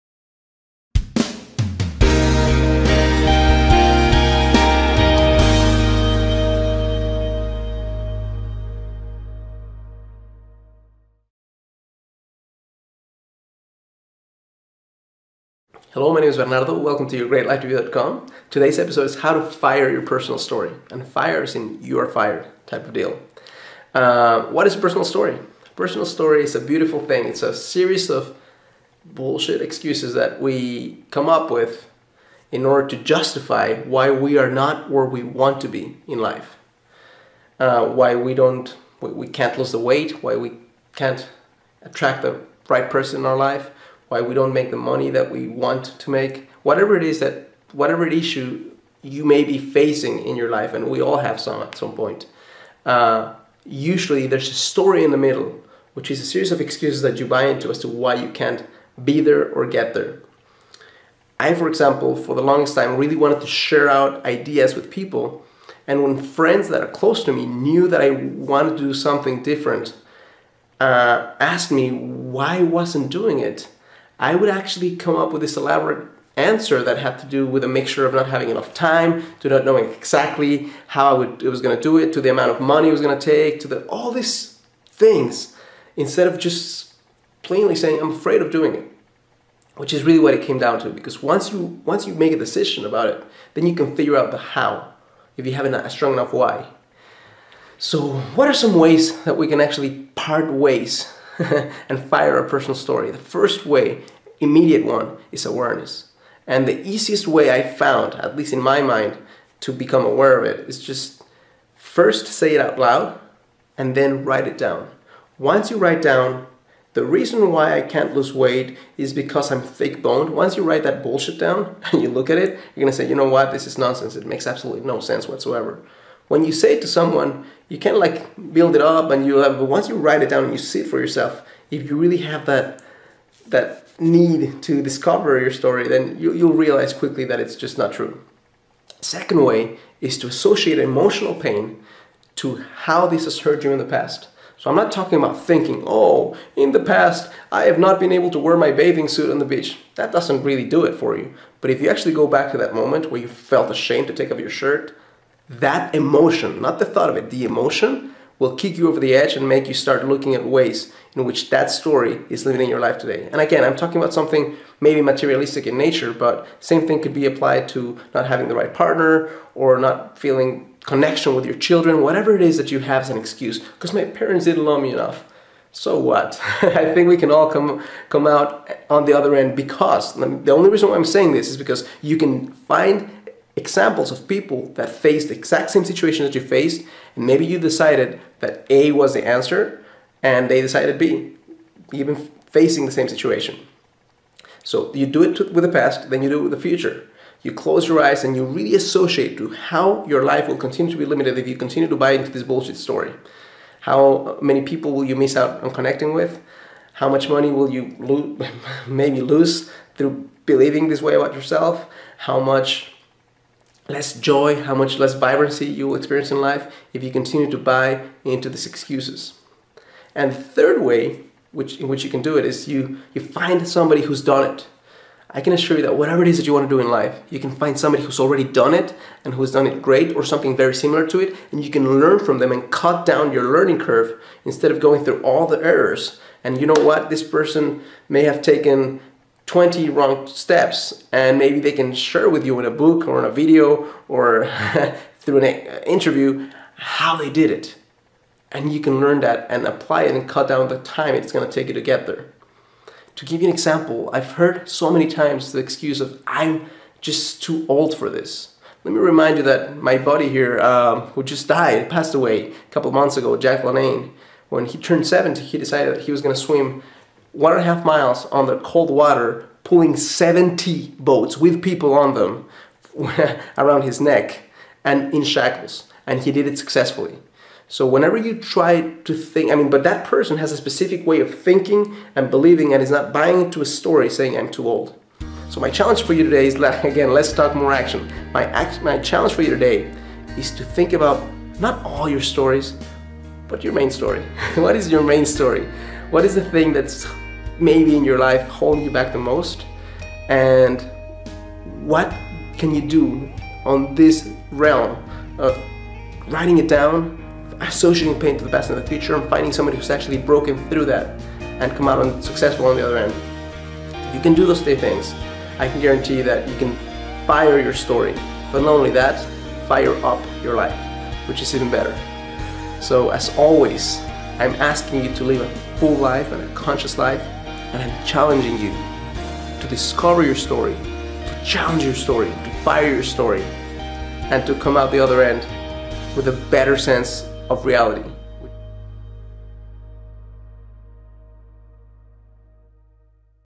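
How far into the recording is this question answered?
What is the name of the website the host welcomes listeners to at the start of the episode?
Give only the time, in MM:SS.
00:17.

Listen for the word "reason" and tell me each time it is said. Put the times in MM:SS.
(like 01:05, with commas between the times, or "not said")
01:57, 03:00.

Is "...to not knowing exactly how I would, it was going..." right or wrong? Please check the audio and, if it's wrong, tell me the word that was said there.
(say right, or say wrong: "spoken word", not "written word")
right.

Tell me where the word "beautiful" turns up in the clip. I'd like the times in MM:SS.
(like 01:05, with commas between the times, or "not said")
00:26.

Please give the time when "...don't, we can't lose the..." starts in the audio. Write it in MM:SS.
00:38.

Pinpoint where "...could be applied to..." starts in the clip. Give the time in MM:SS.
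02:47.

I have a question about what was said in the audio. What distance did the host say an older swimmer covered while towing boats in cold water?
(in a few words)
1.5 miles.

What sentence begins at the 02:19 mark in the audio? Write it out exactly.
Second way is to associate emotional pain to how this has hurt you in the past.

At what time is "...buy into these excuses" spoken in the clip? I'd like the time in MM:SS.
03:37.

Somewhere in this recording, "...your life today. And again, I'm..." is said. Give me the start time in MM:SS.
02:42.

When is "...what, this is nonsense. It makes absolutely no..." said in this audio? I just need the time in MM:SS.
02:03.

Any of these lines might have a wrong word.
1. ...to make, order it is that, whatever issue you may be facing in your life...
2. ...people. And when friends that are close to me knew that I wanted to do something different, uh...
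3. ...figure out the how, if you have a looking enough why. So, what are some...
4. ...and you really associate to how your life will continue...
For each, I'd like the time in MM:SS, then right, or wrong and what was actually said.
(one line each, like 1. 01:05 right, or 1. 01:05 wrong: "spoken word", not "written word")
1. 00:45 wrong: "whatever", not "order"
2. 01:04 right
3. 01:33 wrong: "strong", not "looking"
4. 03:18 right.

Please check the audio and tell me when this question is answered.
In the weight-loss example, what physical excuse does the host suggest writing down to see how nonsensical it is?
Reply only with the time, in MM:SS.
01:59.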